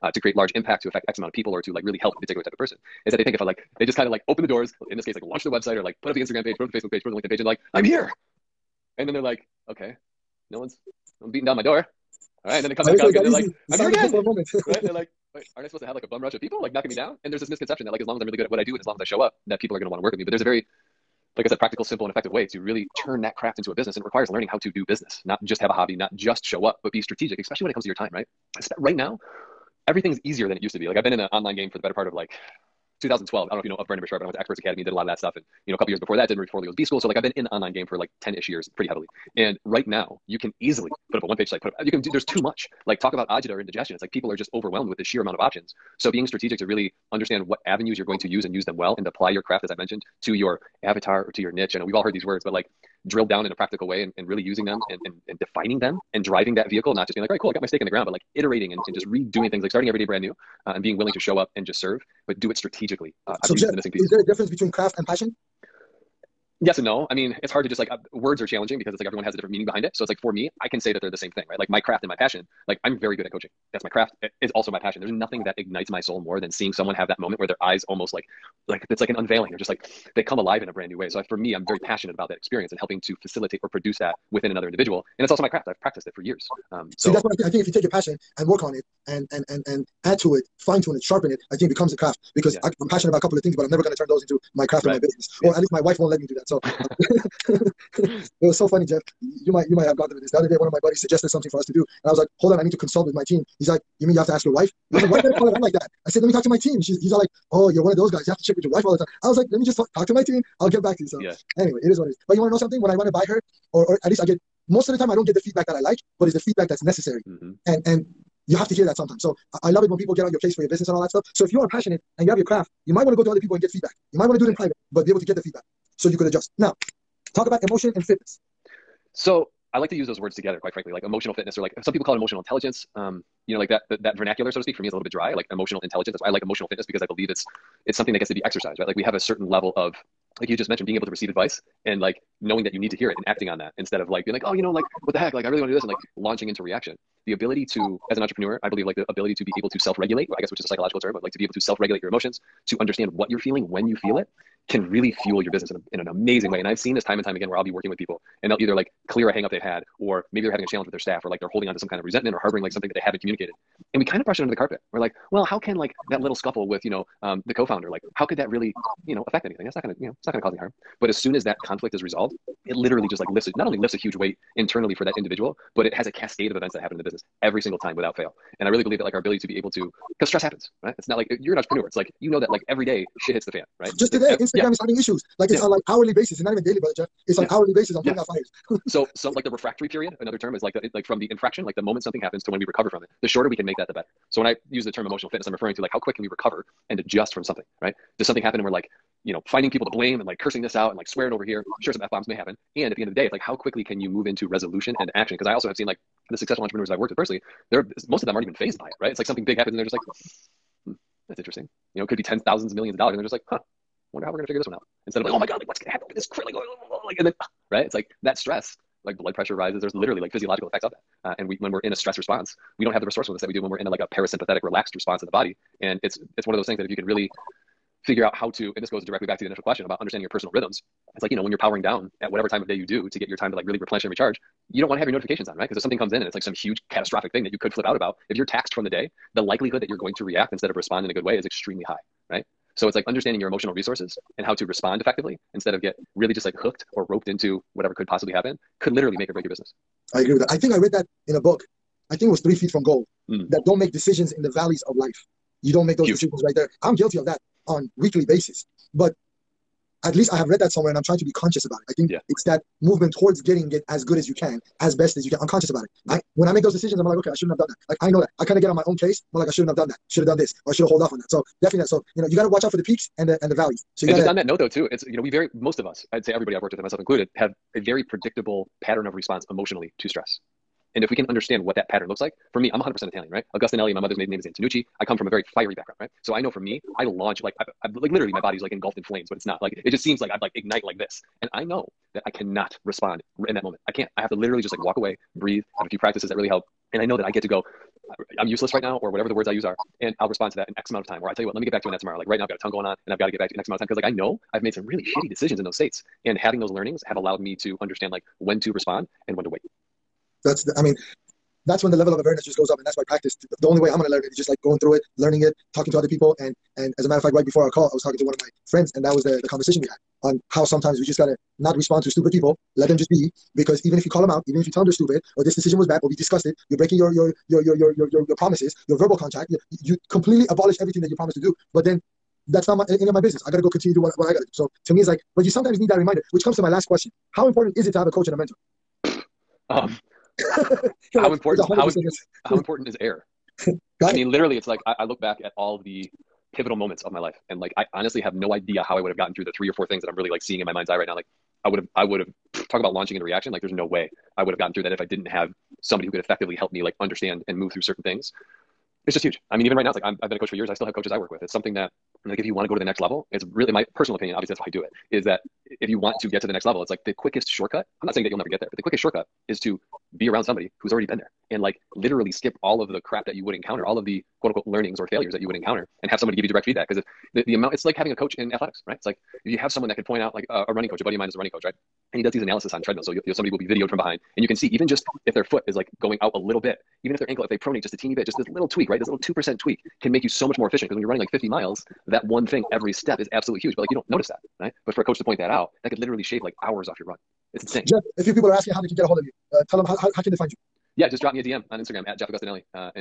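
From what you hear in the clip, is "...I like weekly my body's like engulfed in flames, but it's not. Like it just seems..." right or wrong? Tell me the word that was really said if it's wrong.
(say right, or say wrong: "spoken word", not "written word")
wrong: "literally", not "weekly".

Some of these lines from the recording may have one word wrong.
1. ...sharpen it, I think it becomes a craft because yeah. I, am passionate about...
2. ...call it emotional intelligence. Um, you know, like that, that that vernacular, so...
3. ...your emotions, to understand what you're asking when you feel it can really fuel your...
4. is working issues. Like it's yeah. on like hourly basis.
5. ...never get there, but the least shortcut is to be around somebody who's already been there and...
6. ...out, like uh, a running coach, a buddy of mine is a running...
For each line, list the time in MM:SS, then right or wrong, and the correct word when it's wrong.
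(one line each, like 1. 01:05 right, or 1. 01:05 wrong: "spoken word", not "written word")
1. 01:31 right
2. 02:12 right
3. 02:32 wrong: "feeling", not "asking"
4. 03:04 wrong: "having", not "working"
5. 06:08 wrong: "quickest", not "least"
6. 06:20 right.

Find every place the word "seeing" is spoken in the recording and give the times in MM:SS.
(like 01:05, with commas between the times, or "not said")
01:16, 05:50.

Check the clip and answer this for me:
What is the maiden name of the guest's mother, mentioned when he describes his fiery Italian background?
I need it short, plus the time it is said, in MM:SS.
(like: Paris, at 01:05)
Antonucci, at 04:44.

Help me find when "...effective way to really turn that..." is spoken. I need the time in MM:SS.
00:22.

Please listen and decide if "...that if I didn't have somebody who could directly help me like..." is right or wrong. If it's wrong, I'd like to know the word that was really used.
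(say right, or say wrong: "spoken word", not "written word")
wrong: "effectively", not "directly".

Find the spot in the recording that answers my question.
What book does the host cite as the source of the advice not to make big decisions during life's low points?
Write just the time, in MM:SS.
04:12.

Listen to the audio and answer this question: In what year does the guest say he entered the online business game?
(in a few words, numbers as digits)
2012.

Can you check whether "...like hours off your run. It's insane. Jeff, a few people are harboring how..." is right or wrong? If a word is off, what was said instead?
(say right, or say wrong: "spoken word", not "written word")
wrong: "asking", not "harboring".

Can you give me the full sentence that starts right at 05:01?
Or I tell you what, let me get back to you on that tomorrow.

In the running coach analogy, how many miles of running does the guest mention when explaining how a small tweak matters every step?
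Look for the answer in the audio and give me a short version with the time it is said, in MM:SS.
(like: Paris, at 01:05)
50, at 06:31.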